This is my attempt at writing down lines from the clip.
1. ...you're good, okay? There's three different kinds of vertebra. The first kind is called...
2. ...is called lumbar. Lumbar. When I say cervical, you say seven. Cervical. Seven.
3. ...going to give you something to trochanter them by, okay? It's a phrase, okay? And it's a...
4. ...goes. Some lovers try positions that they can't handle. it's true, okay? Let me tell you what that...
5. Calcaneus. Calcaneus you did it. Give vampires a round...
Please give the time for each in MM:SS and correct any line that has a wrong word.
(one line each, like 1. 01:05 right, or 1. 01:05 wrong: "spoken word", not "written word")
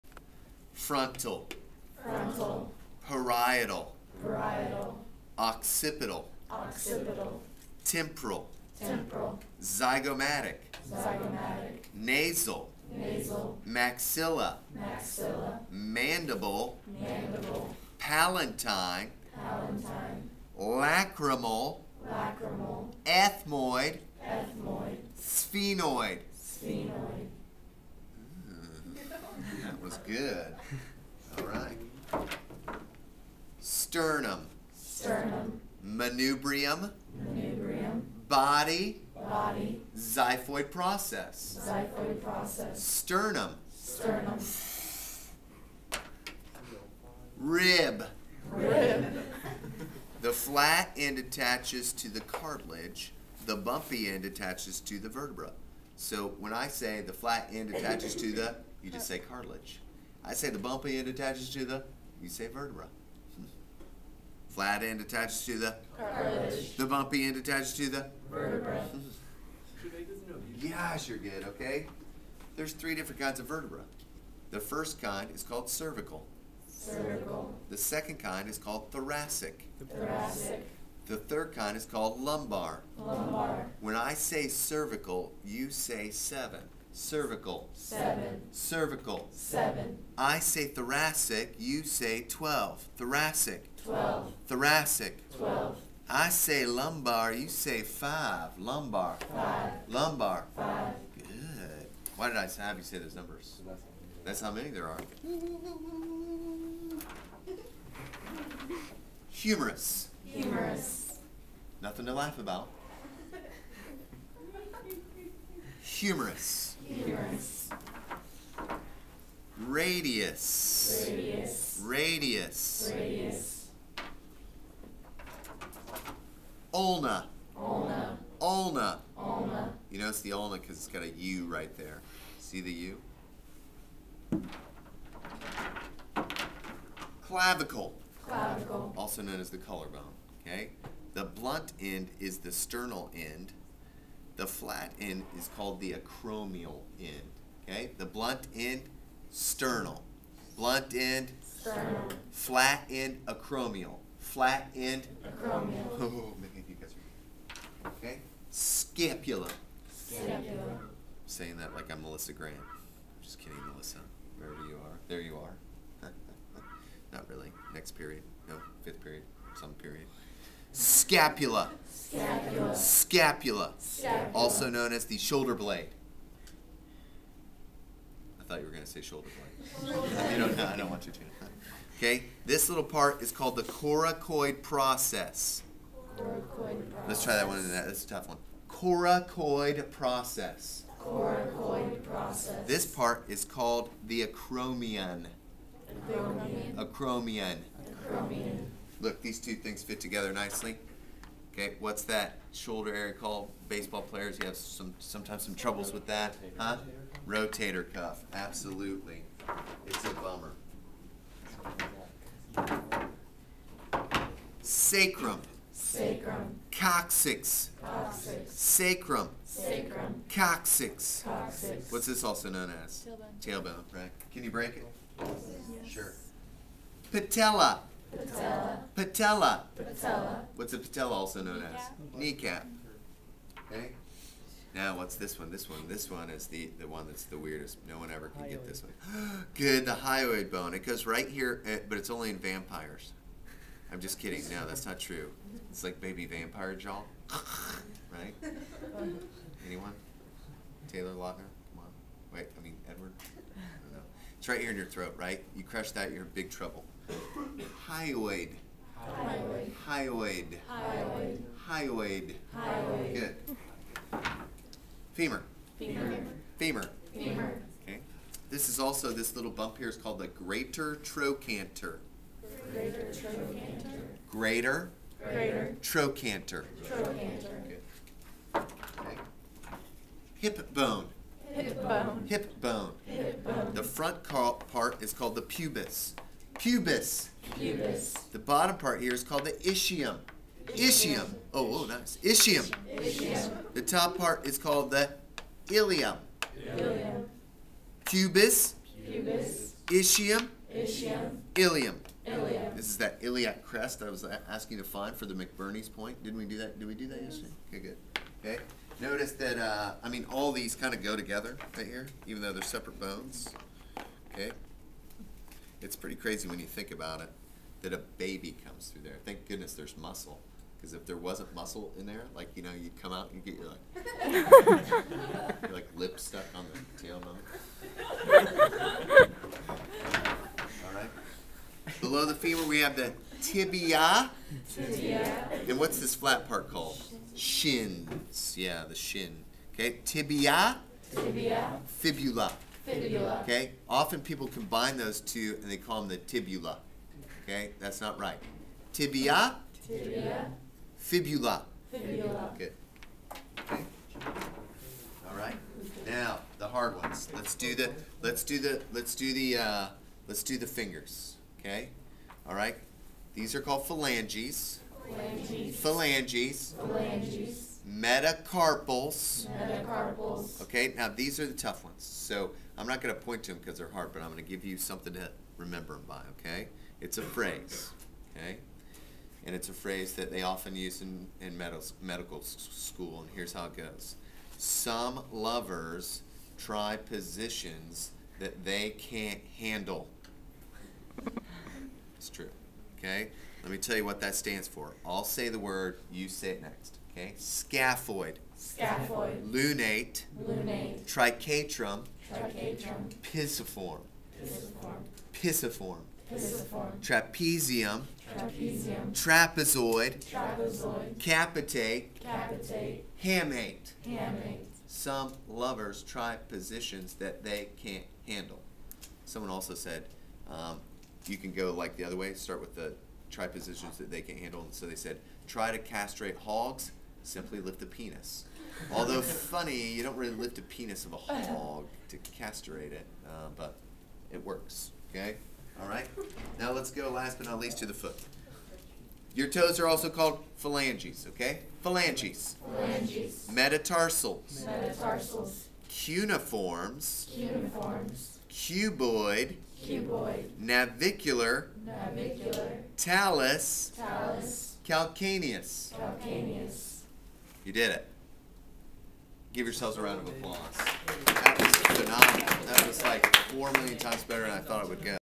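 1. 01:11 right
2. 01:21 right
3. 06:14 wrong: "remember", not "trochanter"
4. 06:23 right
5. 07:34 wrong: "yourselves", not "vampires".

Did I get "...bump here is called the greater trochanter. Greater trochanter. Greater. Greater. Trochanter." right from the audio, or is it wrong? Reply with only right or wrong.
right.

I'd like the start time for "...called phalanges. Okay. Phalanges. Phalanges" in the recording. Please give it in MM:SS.
07:20.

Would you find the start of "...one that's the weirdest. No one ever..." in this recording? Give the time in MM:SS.
03:56.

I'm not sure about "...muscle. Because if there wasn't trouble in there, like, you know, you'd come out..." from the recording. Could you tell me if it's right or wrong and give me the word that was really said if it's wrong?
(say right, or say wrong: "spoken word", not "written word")
wrong: "muscle", not "trouble".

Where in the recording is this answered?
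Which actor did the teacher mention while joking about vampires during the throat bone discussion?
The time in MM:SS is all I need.
04:10.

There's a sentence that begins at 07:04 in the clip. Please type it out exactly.
And so they said try to castrate hogs Simply lift a penis.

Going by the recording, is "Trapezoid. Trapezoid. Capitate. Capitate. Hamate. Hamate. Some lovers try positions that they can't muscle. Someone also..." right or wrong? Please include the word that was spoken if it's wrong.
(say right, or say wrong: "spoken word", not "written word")
wrong: "handle", not "muscle".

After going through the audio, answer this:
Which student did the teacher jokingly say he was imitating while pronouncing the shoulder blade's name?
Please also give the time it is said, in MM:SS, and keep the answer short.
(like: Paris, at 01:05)
Melissa Grant, at 02:42.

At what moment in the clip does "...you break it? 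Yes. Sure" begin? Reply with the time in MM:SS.
03:44.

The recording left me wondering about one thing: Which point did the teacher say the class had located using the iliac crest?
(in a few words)
McBurney's point.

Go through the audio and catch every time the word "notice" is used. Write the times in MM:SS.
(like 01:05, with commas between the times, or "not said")
02:09, 05:08.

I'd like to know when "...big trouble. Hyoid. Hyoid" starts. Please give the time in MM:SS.
04:16.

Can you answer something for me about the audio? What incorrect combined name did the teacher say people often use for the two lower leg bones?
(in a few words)
tibula.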